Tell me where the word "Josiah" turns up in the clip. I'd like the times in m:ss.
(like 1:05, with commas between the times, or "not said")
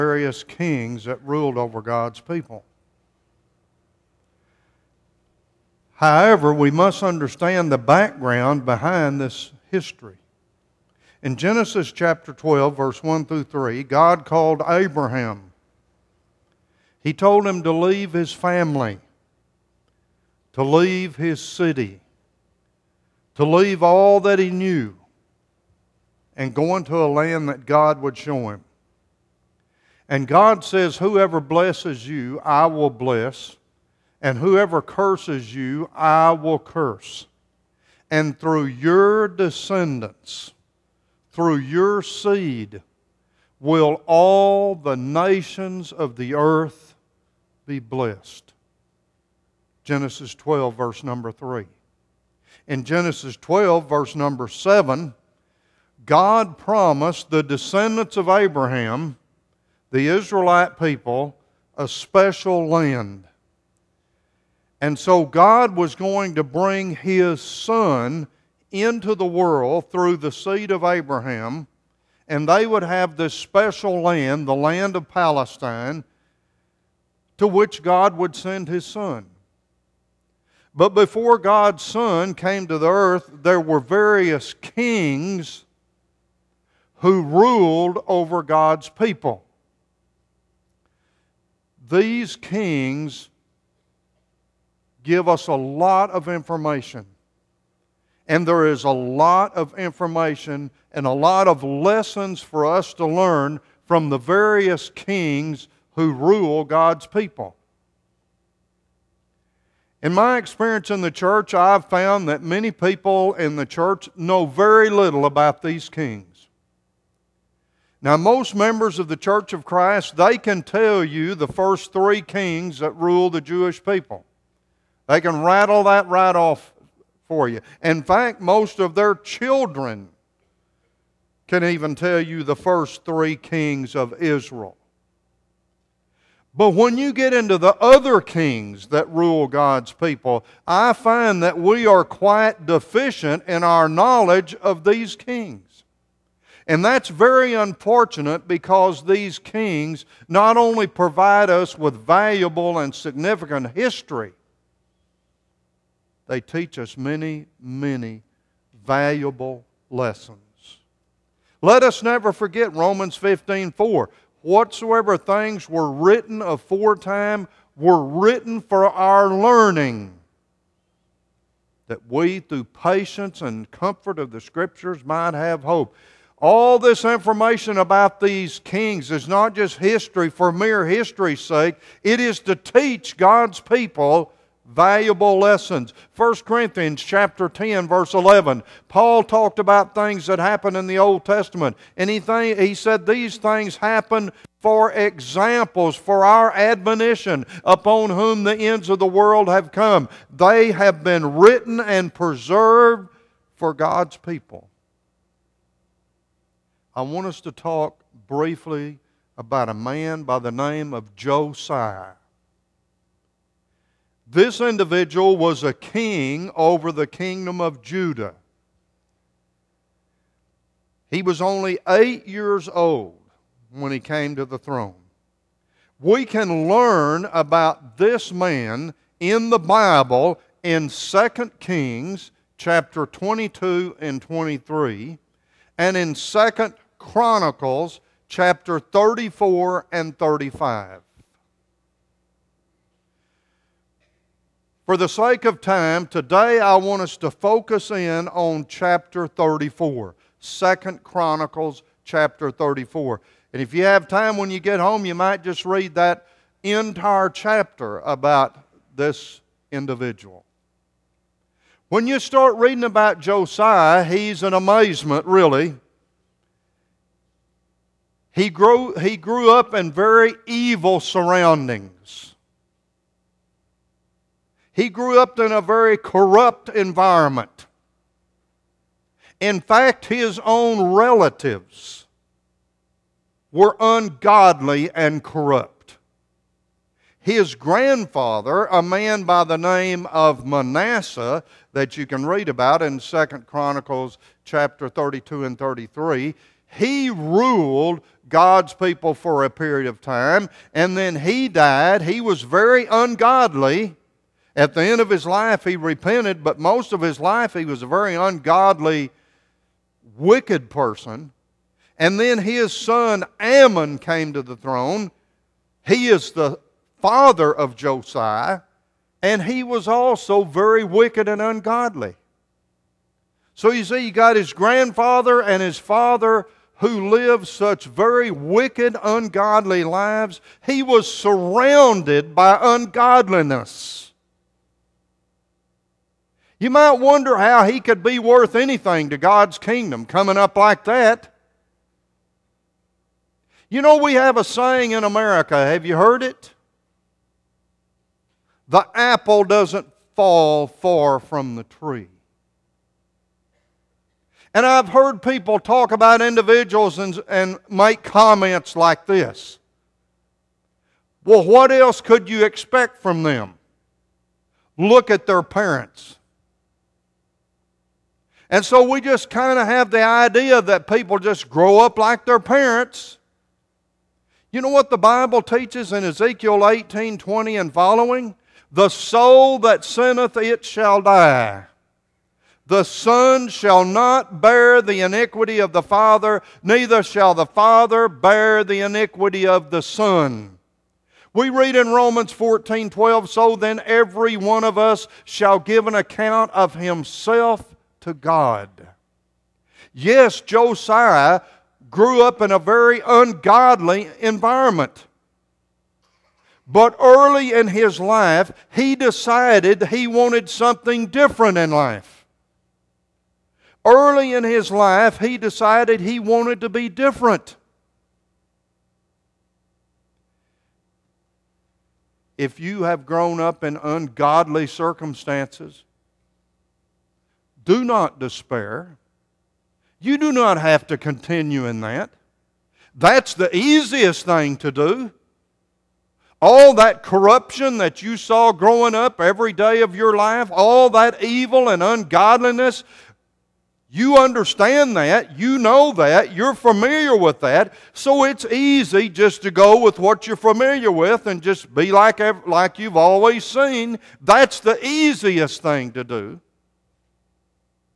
3:31, 4:23, 5:17, 6:40.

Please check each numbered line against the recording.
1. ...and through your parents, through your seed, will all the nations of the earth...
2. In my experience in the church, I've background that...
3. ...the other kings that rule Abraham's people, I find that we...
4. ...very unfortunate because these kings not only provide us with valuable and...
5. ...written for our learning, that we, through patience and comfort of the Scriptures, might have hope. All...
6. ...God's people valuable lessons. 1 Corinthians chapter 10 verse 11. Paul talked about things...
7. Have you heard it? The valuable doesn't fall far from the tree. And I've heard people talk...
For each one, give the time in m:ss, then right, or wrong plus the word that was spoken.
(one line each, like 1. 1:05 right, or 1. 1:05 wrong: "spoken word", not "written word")
1. 0:38 wrong: "descendants", not "parents"
2. 1:50 wrong: "found", not "background"
3. 2:17 wrong: "God", not "Abraham"
4. 2:27 right
5. 2:48 right
6. 3:03 right
7. 5:45 wrong: "apple", not "valuable".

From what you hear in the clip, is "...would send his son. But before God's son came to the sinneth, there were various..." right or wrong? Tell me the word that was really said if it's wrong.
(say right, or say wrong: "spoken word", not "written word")
wrong: "earth", not "sinneth".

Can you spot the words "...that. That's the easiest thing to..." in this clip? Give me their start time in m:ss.
7:11.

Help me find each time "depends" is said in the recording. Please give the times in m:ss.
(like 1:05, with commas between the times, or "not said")
not said.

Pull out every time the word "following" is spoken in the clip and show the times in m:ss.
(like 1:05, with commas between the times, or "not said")
6:17.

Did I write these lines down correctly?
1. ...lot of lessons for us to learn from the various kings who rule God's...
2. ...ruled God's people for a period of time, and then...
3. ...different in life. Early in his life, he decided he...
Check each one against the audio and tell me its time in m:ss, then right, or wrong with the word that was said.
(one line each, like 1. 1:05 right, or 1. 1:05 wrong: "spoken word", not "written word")
1. 1:41 right
2. 4:57 right
3. 6:51 right.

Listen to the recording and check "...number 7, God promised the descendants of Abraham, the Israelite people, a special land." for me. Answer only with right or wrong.
right.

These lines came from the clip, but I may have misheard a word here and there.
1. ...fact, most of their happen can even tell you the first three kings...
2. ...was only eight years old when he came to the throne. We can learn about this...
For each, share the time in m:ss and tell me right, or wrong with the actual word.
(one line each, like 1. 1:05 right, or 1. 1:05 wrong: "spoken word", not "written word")
1. 2:08 wrong: "children", not "happen"
2. 3:41 right.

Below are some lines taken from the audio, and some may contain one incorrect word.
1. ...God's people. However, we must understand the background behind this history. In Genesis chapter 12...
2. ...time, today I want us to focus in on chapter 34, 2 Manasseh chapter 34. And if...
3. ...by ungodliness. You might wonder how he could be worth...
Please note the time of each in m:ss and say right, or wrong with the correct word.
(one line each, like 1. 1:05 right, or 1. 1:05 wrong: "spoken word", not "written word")
1. 0:01 right
2. 4:05 wrong: "Chronicles", not "Manasseh"
3. 5:32 right.